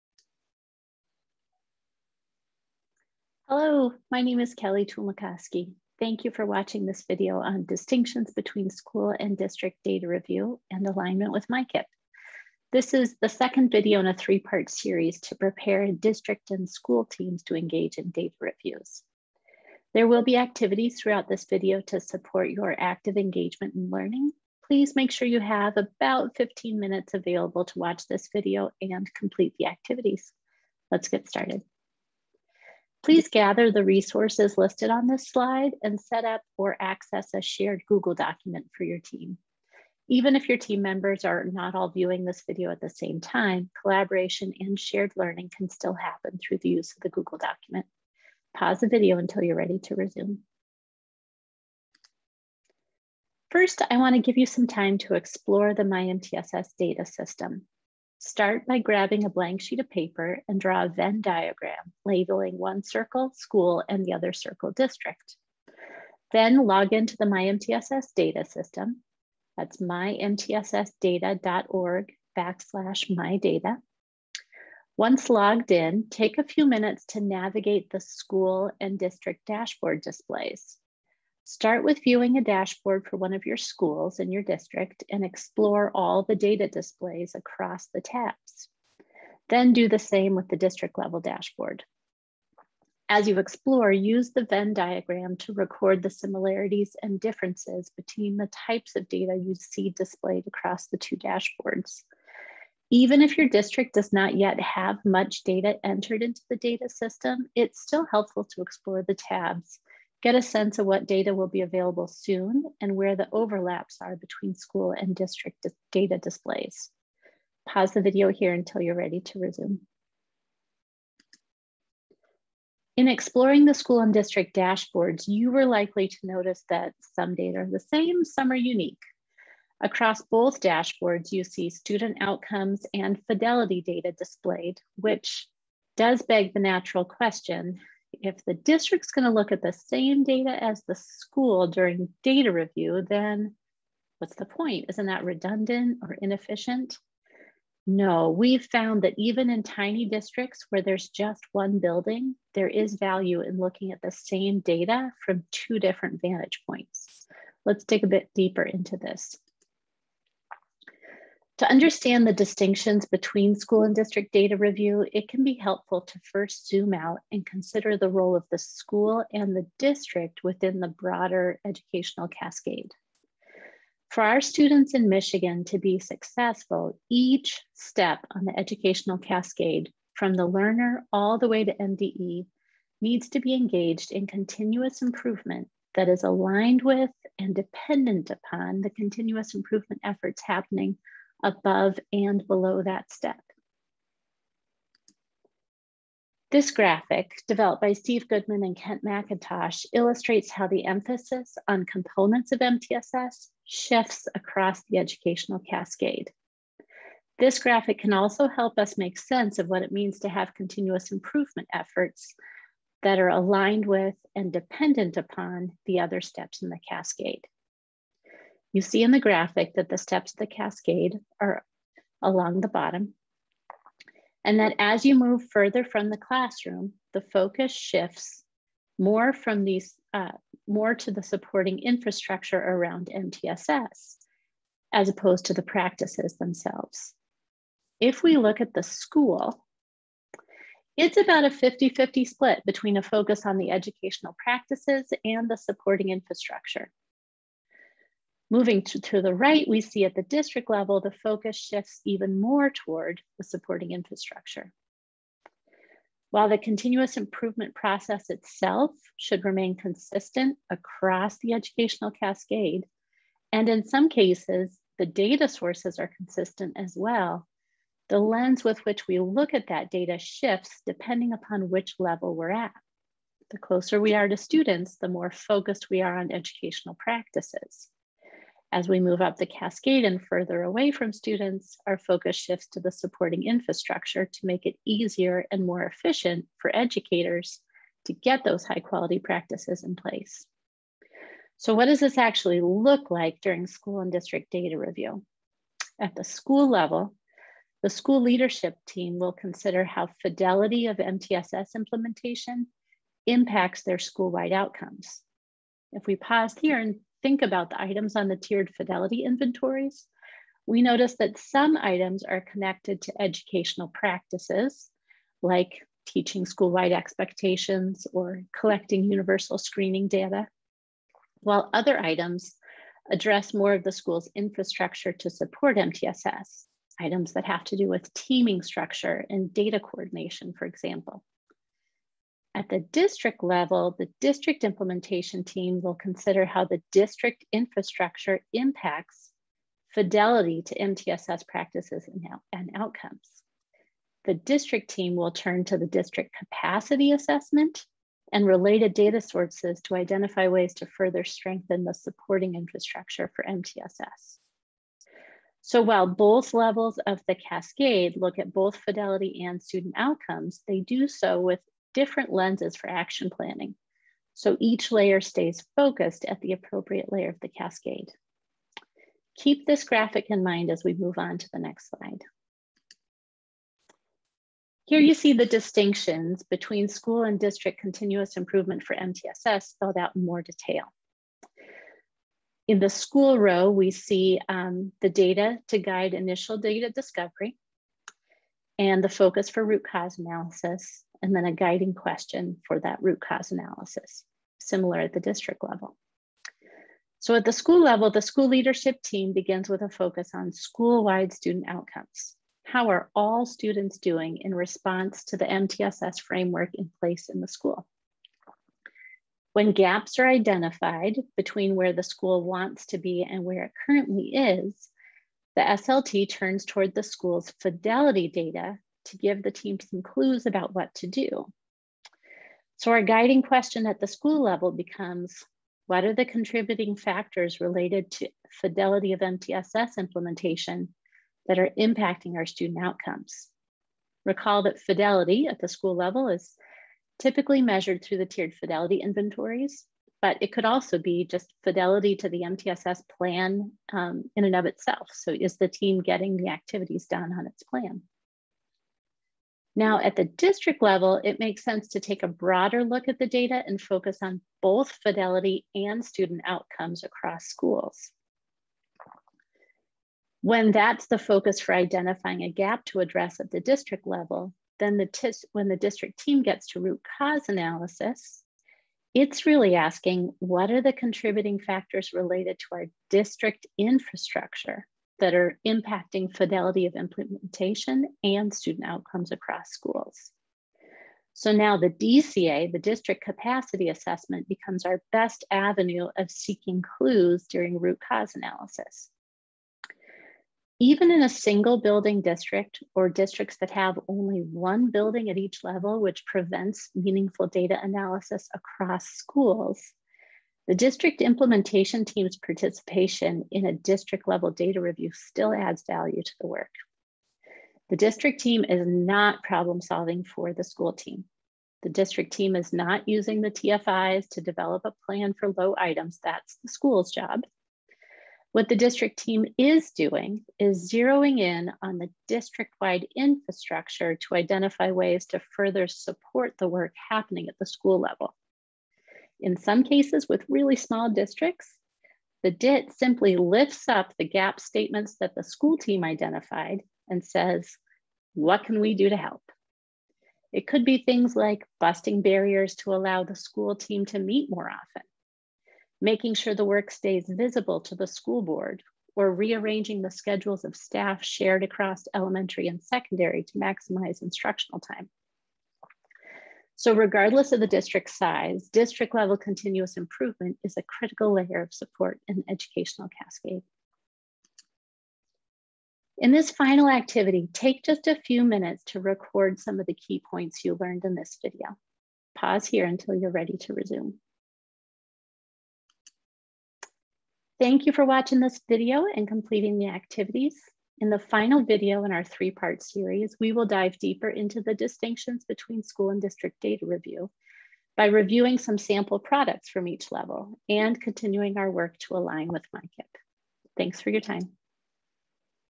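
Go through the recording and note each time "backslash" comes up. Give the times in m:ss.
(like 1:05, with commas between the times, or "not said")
1:12.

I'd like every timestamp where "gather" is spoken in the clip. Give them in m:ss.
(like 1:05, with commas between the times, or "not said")
0:33.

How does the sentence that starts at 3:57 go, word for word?
If we look at the school, it's about a 50-50 split between a focus on the educational practices and the supporting infrastructure.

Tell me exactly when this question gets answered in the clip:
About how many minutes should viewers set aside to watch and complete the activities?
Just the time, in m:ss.
0:26.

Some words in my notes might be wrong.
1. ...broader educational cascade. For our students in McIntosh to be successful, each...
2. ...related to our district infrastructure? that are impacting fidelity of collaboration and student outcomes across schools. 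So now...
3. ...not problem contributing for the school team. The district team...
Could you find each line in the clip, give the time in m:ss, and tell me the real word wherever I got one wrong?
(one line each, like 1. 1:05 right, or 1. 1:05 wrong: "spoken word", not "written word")
1. 2:50 wrong: "Michigan", not "McIntosh"
2. 7:52 wrong: "implementation", not "collaboration"
3. 8:28 wrong: "solving", not "contributing".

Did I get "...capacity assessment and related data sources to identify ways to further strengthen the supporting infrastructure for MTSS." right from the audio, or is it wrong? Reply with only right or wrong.
right.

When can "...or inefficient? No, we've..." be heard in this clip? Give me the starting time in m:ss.
2:26.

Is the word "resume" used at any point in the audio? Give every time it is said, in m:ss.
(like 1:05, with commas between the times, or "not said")
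0:49, 1:59, 9:33.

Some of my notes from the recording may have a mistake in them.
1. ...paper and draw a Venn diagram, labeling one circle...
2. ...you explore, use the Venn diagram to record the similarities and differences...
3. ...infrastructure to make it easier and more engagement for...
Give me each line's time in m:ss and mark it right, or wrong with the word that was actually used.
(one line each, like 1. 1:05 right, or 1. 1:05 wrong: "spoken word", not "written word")
1. 0:59 right
2. 1:33 right
3. 4:43 wrong: "efficient", not "engagement".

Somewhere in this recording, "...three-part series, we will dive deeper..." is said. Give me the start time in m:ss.
9:42.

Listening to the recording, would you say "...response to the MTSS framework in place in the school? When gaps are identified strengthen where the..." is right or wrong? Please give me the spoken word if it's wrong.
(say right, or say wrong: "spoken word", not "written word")
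wrong: "between", not "strengthen".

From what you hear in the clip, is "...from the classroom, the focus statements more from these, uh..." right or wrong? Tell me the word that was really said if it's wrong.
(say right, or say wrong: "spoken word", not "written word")
wrong: "shifts", not "statements".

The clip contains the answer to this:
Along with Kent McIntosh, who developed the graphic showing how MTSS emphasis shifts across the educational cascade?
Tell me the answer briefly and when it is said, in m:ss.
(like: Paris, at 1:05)
Steve Goodman, at 3:17.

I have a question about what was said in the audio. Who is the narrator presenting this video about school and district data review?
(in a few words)
Kelly Tulmakoski.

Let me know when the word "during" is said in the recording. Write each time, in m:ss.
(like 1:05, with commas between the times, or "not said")
2:21, 4:53, 8:07.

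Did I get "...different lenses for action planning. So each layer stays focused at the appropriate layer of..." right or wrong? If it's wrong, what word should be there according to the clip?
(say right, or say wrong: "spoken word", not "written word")
right.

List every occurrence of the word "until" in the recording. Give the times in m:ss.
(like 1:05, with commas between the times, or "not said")
0:49, 1:58, 9:32.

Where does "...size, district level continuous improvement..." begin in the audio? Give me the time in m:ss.
9:18.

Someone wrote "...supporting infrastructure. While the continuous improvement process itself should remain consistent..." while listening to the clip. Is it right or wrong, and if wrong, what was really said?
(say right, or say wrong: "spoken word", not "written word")
right.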